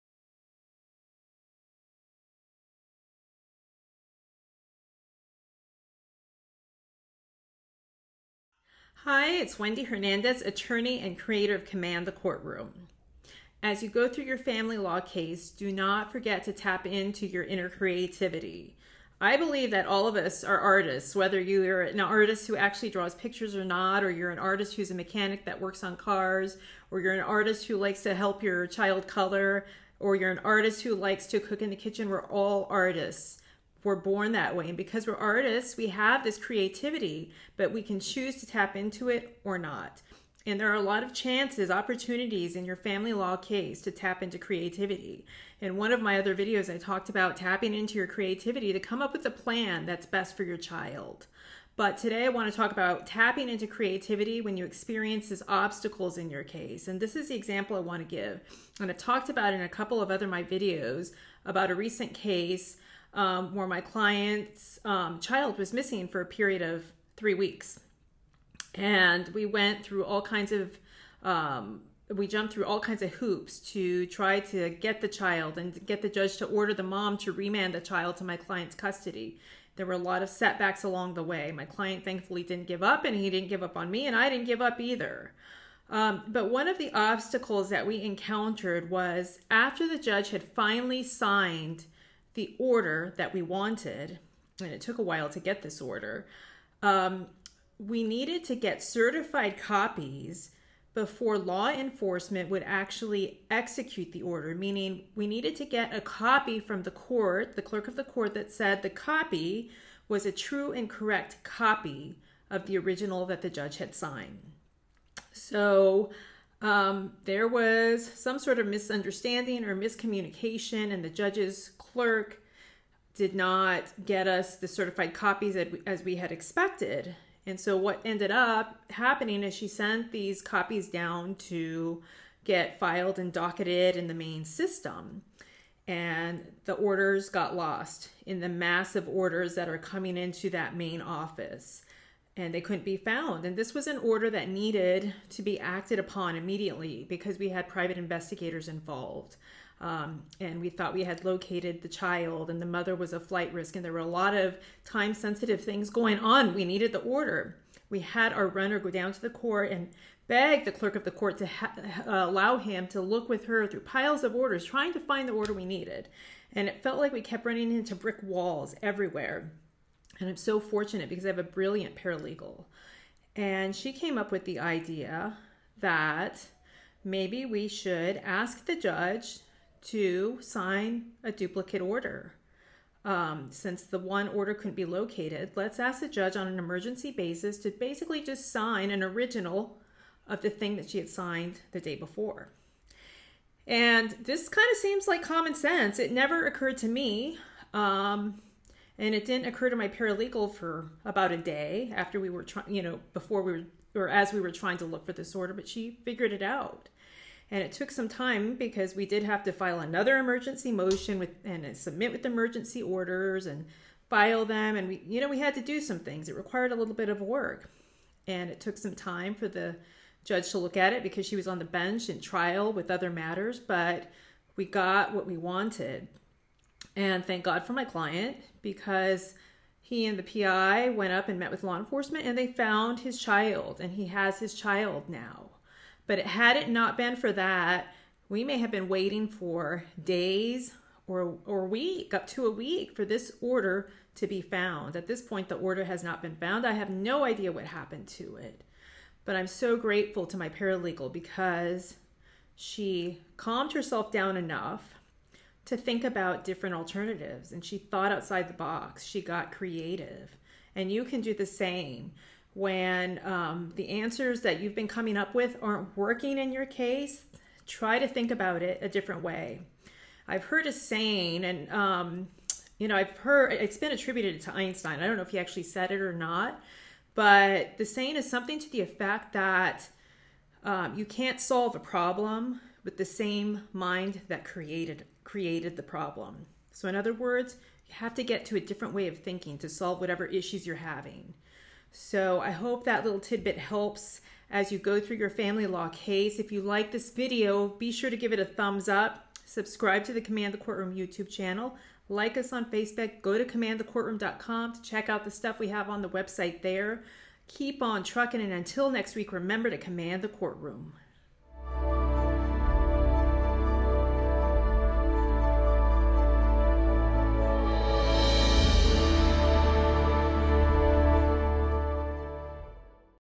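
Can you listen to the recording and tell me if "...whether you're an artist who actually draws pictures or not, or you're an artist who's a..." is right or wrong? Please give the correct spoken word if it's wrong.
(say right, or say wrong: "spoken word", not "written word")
right.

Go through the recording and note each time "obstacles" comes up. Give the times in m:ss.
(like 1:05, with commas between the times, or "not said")
0:55, 1:26.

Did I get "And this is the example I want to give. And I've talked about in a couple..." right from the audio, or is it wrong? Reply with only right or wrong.
right.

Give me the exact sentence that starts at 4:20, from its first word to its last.
And you can do the same when um, the answers that you've been coming up with aren't working in your case.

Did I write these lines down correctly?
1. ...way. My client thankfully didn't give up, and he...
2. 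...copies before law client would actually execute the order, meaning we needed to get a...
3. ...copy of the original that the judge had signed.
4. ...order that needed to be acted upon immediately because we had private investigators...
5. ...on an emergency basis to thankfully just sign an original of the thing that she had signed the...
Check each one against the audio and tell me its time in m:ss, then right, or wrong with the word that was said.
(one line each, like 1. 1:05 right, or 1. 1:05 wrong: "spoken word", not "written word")
1. 1:21 right
2. 1:39 wrong: "enforcement", not "client"
3. 1:51 right
4. 2:23 right
5. 3:06 wrong: "basically", not "thankfully".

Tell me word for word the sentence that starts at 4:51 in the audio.
So, I hope that little tidbit helps as you go through your family law case.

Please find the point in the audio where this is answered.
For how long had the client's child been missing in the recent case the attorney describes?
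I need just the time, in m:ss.
1:07.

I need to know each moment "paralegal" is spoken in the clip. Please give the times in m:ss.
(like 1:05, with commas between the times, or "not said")
2:51, 3:19, 4:10.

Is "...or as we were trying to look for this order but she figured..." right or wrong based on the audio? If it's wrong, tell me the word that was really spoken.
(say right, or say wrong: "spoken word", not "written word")
right.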